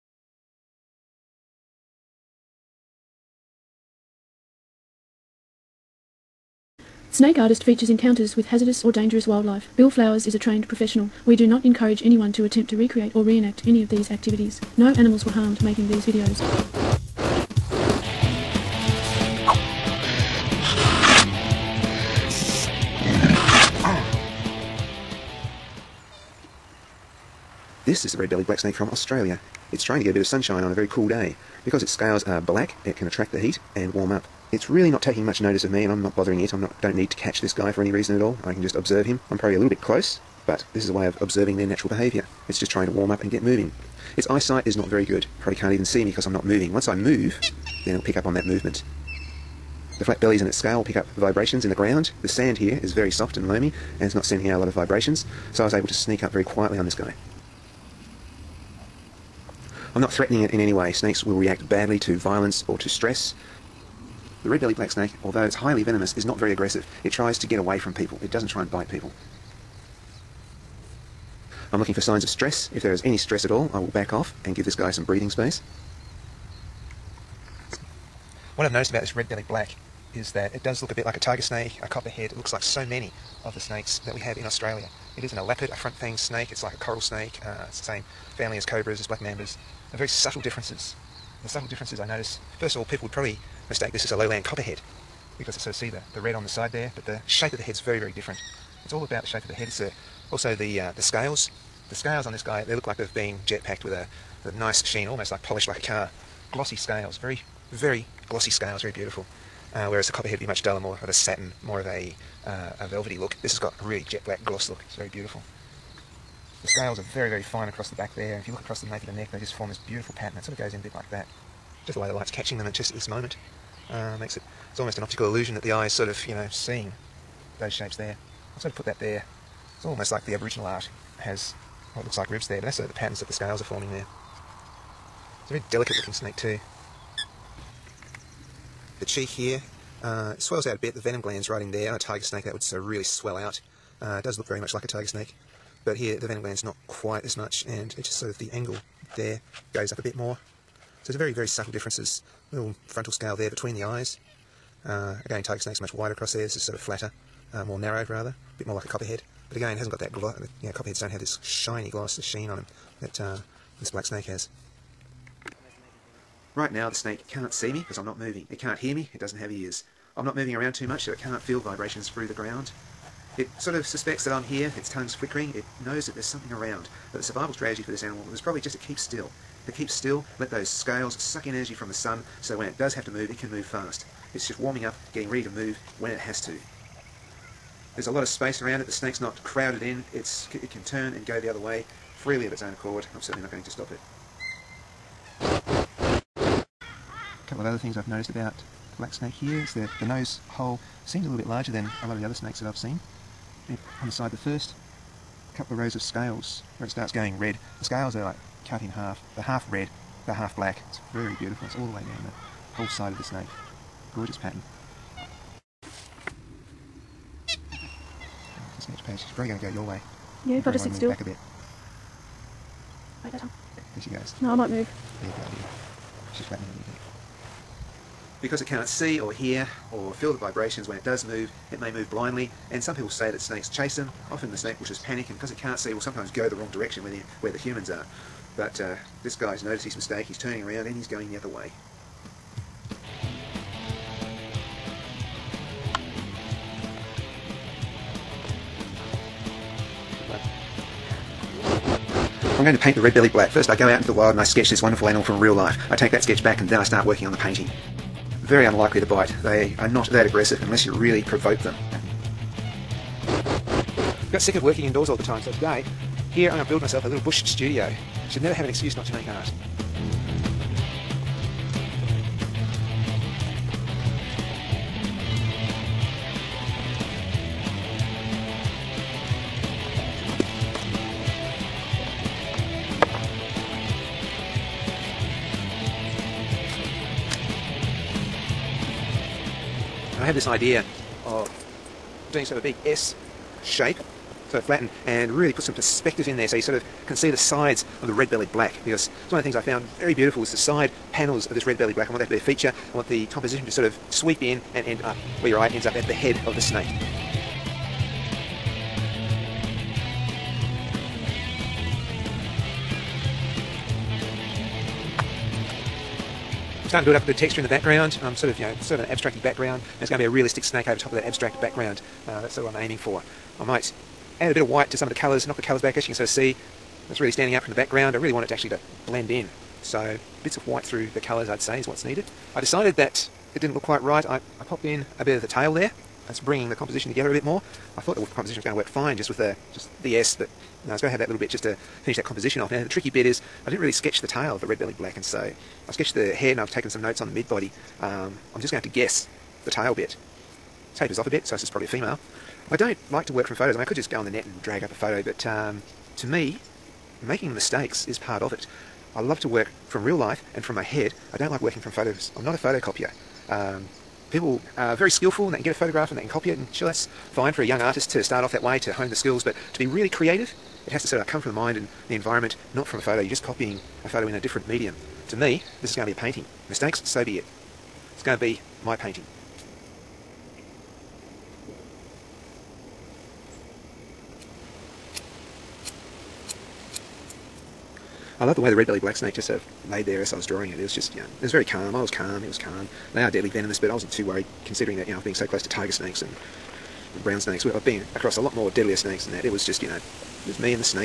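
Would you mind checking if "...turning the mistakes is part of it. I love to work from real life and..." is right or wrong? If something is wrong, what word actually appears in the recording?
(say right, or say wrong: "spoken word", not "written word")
wrong: "making", not "turning".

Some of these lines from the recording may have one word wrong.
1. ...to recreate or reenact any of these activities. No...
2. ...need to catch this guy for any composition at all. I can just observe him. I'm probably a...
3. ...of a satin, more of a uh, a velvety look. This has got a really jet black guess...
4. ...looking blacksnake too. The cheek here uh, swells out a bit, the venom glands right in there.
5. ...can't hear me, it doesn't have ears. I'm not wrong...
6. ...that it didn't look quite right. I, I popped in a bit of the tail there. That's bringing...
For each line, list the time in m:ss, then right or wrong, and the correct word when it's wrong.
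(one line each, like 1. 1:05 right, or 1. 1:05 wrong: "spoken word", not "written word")
1. 0:12 right
2. 0:36 wrong: "reason", not "composition"
3. 1:51 wrong: "gloss", not "guess"
4. 2:15 wrong: "snake", not "blacksnake"
5. 2:48 wrong: "moving", not "wrong"
6. 5:32 right.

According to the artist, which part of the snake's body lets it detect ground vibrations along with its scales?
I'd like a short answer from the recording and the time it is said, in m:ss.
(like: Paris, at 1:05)
Flat bellies, at 0:50.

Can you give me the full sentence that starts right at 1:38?
It's all about the shape of the head.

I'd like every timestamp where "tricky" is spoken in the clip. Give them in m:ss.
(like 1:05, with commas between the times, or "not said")
5:42.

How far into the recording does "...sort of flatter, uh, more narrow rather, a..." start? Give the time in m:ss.
2:36.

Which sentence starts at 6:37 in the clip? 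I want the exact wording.
I've been across a lot more deadlier snakes than that.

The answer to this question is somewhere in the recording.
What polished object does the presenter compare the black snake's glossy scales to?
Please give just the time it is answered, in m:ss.
1:45.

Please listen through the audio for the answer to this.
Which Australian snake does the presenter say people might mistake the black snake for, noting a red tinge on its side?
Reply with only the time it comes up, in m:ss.
1:34.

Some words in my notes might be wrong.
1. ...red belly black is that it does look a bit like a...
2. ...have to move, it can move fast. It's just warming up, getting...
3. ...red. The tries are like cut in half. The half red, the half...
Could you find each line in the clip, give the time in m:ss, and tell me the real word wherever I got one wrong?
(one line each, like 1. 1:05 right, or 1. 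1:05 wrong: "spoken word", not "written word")
1. 1:19 right
2. 3:02 right
3. 3:27 wrong: "scales", not "tries".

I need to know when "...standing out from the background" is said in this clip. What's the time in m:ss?
5:27.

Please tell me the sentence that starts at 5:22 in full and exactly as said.
Uh, that's sort of what I'm aiming for.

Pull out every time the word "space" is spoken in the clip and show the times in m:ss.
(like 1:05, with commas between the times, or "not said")
1:15, 3:08.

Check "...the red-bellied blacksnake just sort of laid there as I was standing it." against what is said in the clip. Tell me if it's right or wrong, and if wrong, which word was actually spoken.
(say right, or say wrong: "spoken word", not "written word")
wrong: "drawing", not "standing".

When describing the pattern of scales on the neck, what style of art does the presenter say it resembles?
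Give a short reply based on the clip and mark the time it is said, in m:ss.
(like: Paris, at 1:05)
Aboriginal art, at 2:10.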